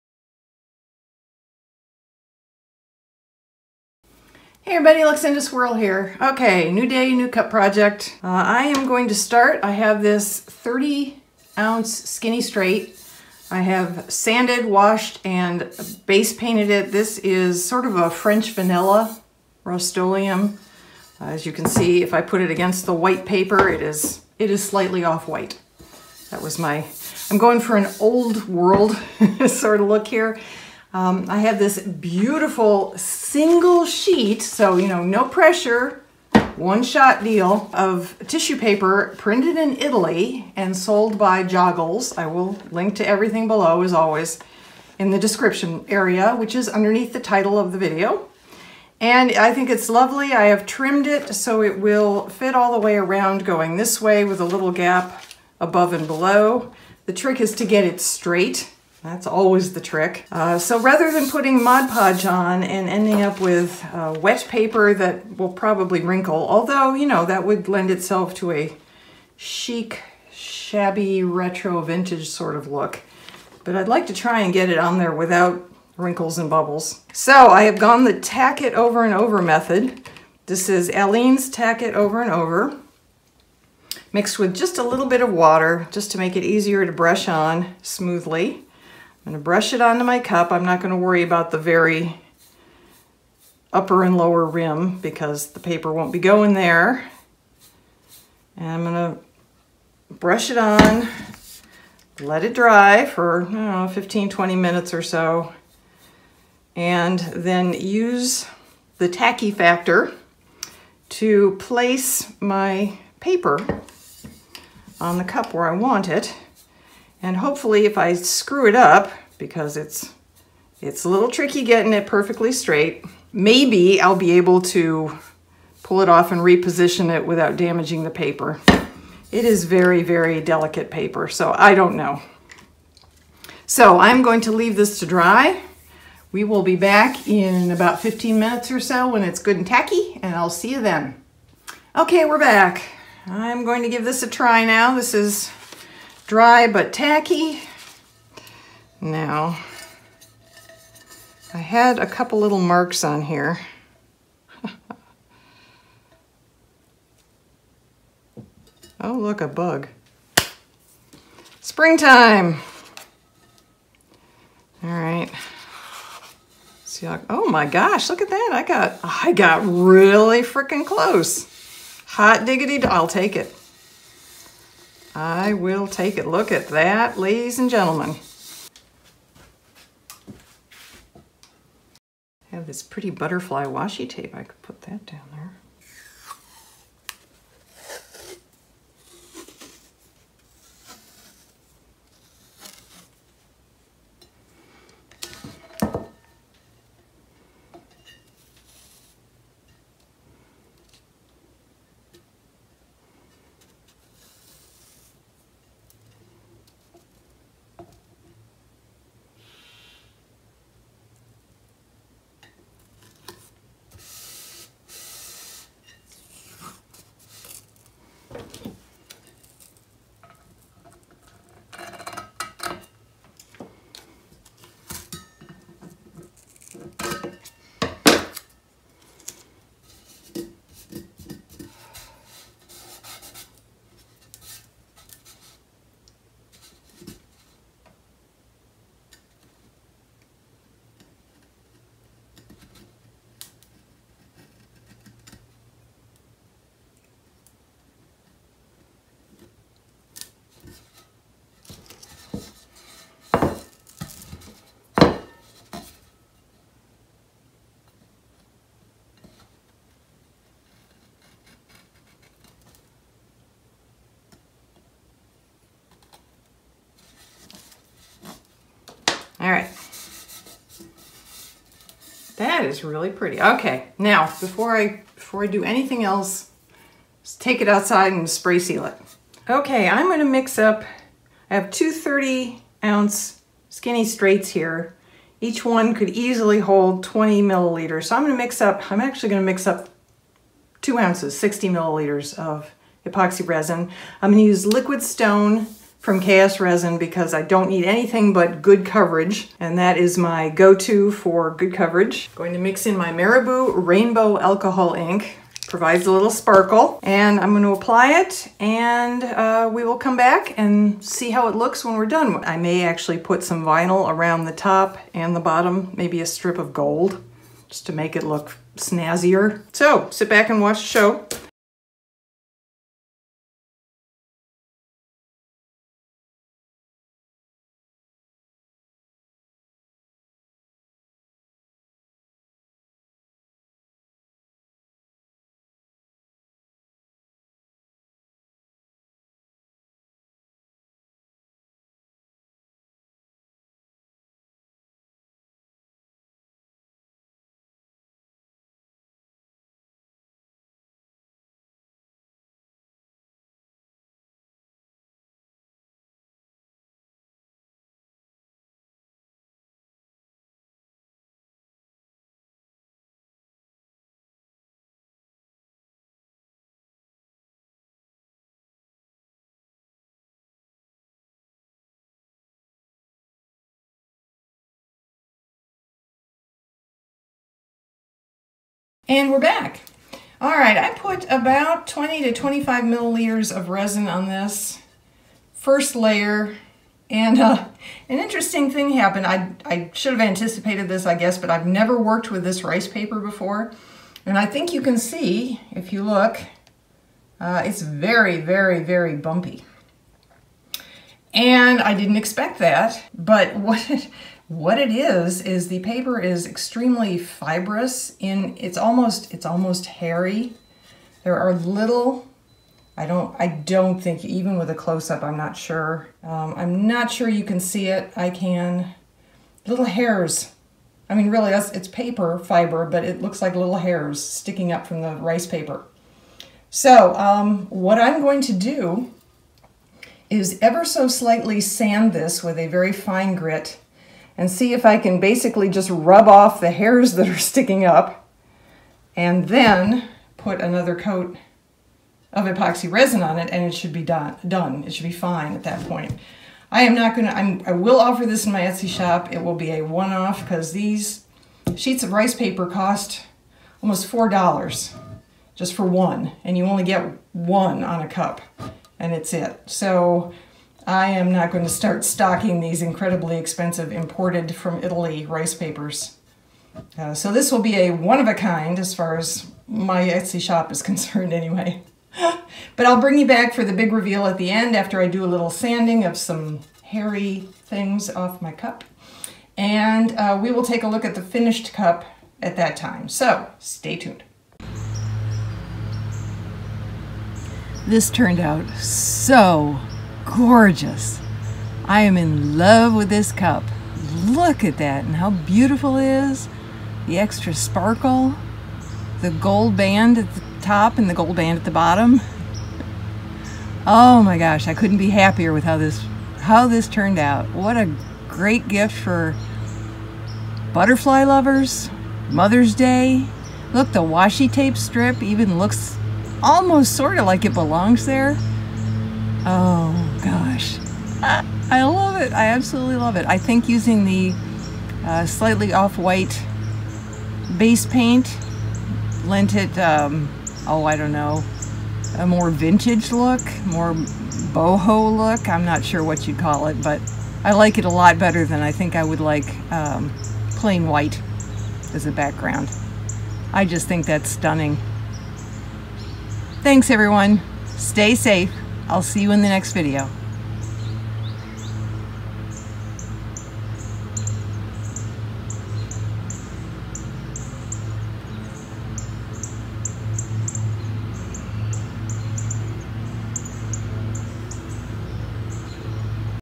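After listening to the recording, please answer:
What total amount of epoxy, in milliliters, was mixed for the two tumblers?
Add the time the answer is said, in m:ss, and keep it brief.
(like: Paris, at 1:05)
60 milliliters, at 4:51.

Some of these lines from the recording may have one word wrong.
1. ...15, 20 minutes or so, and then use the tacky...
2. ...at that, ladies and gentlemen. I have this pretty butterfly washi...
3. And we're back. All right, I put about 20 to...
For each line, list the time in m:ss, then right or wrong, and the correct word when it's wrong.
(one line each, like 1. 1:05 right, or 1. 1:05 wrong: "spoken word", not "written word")
1. 1:43 right
2. 2:56 right
3. 6:19 right.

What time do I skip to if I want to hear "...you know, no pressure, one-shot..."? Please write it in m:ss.
0:34.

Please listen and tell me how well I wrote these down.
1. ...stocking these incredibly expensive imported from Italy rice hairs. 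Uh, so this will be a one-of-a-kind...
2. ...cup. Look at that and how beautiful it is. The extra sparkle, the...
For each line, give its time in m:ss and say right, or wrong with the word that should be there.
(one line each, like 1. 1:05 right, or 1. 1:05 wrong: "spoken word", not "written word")
1. 7:42 wrong: "papers", not "hairs"
2. 8:13 right.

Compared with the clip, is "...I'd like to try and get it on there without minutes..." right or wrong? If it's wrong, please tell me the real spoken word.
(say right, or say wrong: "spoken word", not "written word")
wrong: "wrinkles", not "minutes".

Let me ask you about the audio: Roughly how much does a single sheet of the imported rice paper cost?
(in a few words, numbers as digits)
$4.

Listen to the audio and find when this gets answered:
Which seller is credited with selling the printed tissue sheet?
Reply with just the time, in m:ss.
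0:41.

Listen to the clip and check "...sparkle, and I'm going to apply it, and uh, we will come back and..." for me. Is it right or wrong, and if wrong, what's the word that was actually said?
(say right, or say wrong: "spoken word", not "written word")
right.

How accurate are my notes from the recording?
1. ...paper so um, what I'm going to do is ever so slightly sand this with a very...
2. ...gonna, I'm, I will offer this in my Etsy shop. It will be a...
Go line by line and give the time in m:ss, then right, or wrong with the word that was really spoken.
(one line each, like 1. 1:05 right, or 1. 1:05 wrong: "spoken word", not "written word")
1. 7:05 right
2. 7:27 right.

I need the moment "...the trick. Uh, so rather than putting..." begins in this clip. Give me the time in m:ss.
0:59.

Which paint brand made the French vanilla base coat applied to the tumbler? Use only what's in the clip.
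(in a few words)
Rust-Oleum.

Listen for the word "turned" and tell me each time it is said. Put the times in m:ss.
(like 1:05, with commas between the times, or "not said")
8:08, 8:26.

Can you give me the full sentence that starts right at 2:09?
It is very, very delicate paper, so I don't know.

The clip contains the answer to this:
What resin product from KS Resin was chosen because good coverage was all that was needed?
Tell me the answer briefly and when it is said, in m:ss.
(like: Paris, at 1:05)
Liquid Stone, at 4:54.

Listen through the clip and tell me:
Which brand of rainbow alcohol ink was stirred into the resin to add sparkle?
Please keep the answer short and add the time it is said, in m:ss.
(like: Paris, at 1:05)
Marabu, at 5:03.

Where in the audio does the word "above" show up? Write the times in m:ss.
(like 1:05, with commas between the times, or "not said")
0:55.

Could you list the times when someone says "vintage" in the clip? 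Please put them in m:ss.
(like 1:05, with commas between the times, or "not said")
1:11, 8:52.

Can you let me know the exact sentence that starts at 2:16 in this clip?
We will be back in about 15 minutes or so when it's good and tacky, and I'll see you then.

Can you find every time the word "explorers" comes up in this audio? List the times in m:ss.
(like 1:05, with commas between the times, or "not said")
not said.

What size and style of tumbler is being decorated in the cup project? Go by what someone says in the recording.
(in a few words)
30 ounce Skinny Straight.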